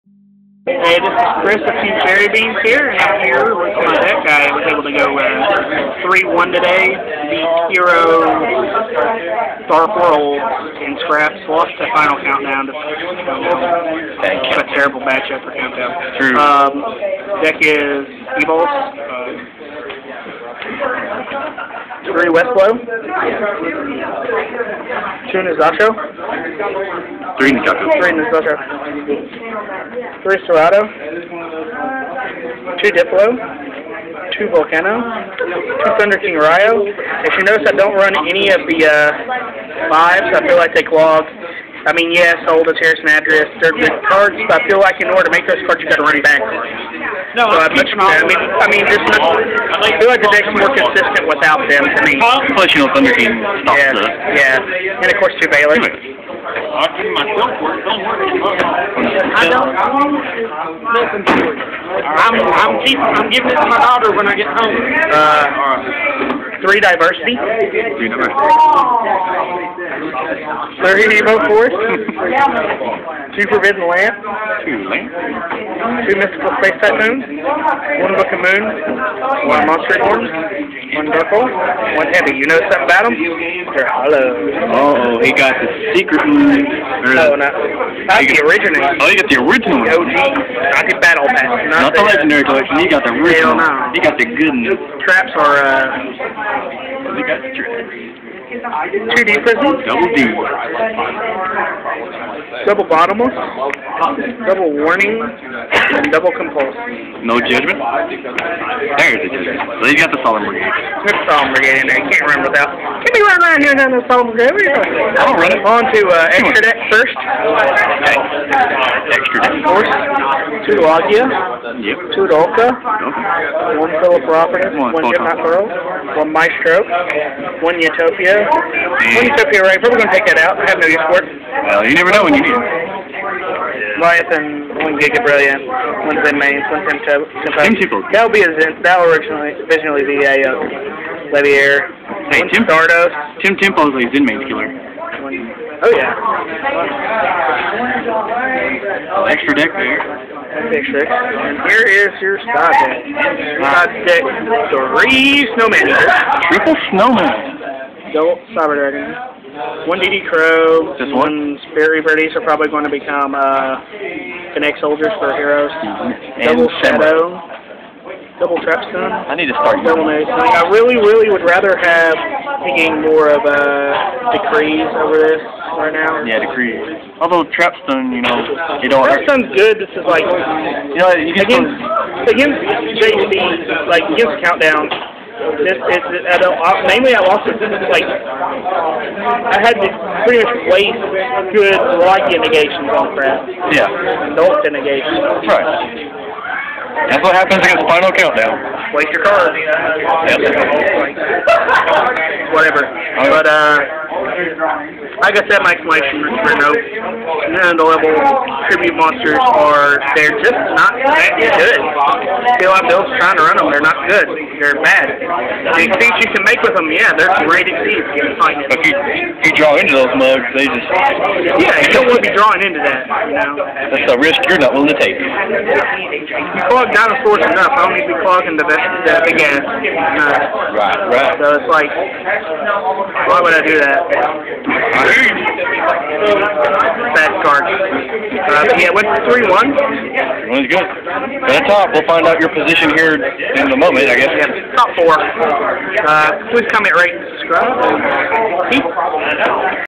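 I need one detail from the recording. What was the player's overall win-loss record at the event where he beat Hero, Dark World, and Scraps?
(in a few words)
3-1.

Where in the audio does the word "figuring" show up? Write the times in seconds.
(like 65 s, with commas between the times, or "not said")
not said.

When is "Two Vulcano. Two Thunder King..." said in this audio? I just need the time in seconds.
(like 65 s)
34 s.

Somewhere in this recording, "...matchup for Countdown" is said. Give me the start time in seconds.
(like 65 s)
15 s.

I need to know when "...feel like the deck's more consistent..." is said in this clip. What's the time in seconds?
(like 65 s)
49 s.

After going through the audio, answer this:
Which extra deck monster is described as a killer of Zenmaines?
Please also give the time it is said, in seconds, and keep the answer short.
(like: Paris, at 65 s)
Tempo, at 143 s.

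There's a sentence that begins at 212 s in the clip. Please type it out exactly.
Still have those trying to run them, they're not good.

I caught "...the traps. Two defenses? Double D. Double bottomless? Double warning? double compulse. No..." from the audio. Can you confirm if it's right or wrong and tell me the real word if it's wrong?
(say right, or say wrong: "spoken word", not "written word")
right.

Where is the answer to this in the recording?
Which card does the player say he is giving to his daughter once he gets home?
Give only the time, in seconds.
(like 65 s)
55 s.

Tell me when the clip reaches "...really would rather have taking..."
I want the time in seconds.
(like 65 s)
170 s.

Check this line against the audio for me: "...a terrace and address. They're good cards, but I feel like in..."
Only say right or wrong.
right.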